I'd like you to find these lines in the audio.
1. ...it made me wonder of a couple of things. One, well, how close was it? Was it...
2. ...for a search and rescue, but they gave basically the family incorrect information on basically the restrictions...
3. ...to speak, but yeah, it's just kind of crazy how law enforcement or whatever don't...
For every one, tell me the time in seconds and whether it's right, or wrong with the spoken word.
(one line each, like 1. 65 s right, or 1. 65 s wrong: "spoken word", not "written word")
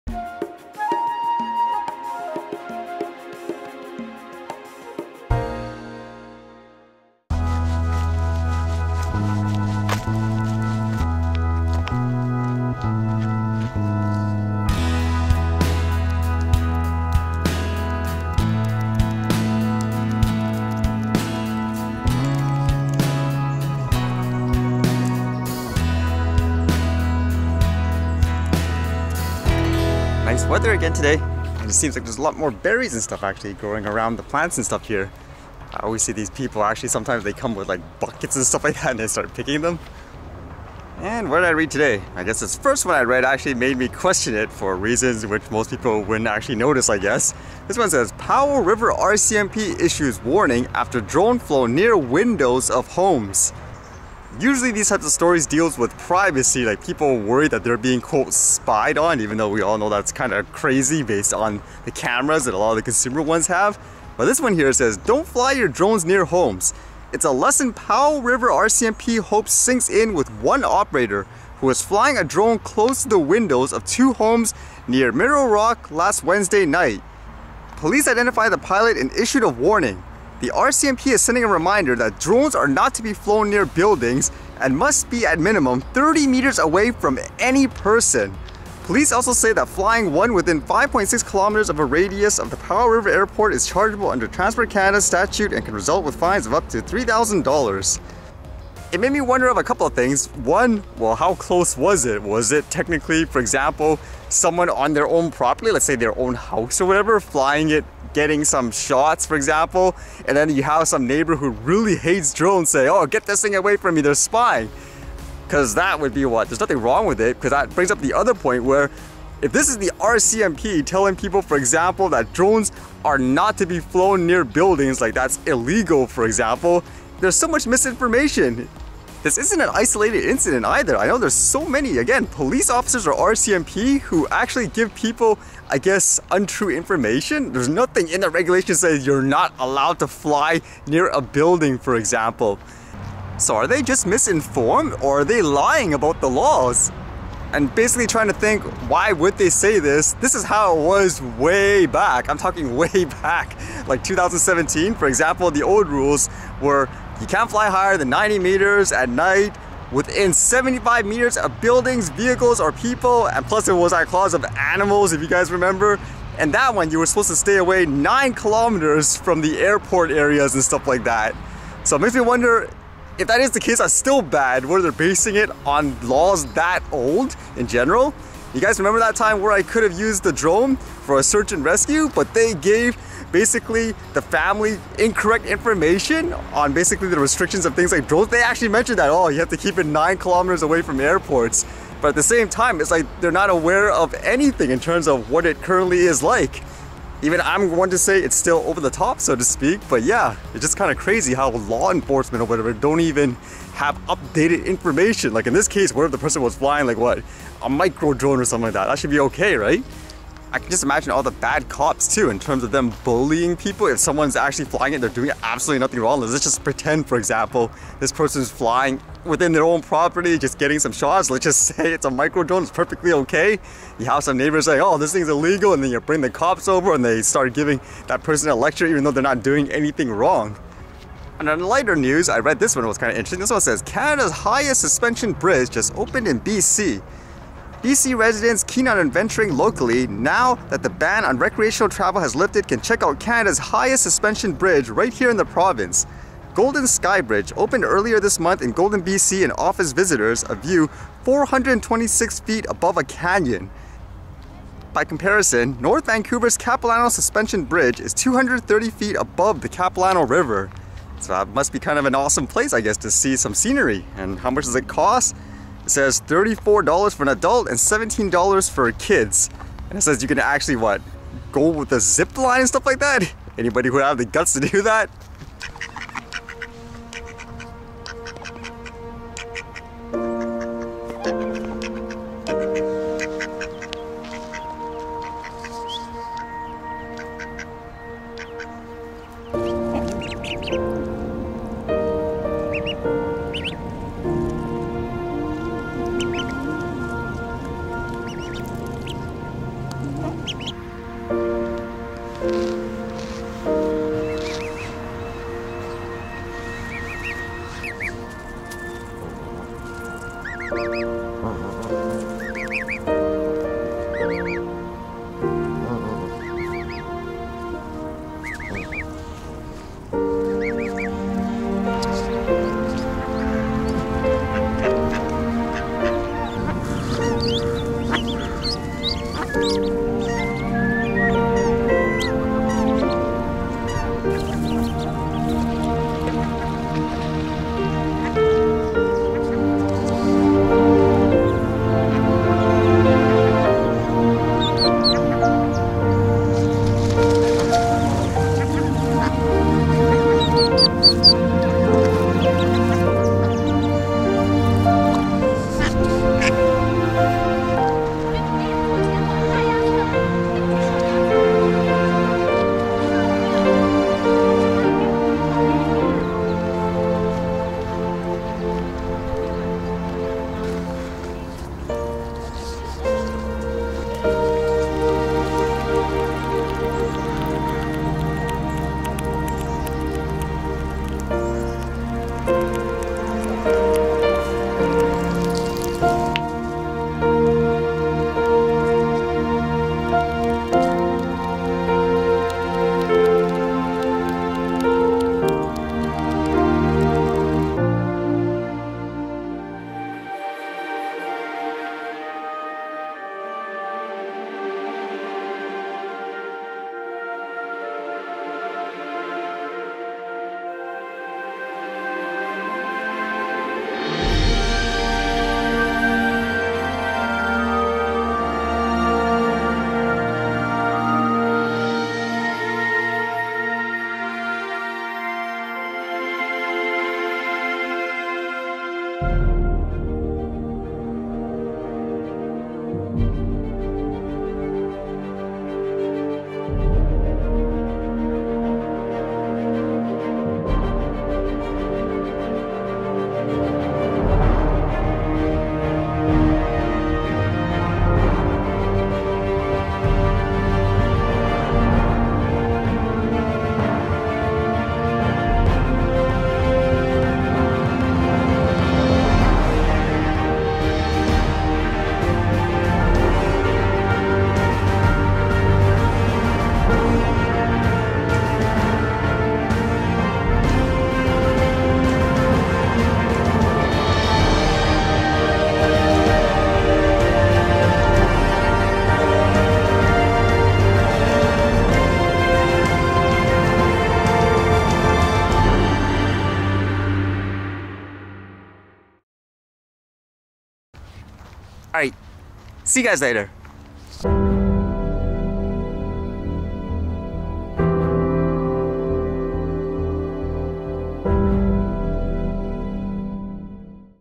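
1. 98 s right
2. 180 s right
3. 199 s right.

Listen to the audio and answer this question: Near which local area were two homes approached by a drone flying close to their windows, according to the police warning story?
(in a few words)
Mineral Rock.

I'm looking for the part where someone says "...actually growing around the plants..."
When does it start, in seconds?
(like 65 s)
33 s.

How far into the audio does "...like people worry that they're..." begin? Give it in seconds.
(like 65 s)
56 s.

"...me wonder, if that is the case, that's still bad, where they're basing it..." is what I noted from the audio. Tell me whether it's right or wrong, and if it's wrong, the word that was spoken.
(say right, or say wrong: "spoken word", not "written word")
right.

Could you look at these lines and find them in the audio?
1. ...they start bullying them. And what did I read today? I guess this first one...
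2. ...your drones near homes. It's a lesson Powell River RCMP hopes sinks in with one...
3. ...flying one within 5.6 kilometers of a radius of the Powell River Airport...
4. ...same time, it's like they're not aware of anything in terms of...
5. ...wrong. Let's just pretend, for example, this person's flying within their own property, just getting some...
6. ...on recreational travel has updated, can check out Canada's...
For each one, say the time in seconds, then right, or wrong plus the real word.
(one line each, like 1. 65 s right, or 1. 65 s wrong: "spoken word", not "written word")
1. 38 s wrong: "picking", not "bullying"
2. 65 s right
3. 89 s right
4. 192 s right
5. 216 s right
6. 241 s wrong: "lifted", not "updated".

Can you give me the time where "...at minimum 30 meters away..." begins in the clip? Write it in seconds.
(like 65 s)
85 s.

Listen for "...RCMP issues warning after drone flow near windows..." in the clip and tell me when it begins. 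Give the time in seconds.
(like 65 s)
48 s.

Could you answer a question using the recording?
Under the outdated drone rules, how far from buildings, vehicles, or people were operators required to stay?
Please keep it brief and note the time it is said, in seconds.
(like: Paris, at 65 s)
75 meters, at 160 s.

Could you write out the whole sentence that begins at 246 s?
Golden Skybridge opened earlier this month in Golden, BC and offers visitors a view 426 feet above a canyon.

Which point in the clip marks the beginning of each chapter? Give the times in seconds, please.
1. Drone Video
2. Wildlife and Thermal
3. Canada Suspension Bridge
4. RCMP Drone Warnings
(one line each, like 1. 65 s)
1. 399 s
2. 275 s
3. 231 s
4. 40 s.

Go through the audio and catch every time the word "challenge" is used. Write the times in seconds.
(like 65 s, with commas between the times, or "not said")
not said.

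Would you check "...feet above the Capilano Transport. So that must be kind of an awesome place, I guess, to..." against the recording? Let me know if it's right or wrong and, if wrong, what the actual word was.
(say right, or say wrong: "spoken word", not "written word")
wrong: "River", not "Transport".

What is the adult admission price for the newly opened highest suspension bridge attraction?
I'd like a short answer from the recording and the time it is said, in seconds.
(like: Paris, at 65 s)
$34, at 266 s.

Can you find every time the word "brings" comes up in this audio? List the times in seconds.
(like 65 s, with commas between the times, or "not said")
117 s, 226 s.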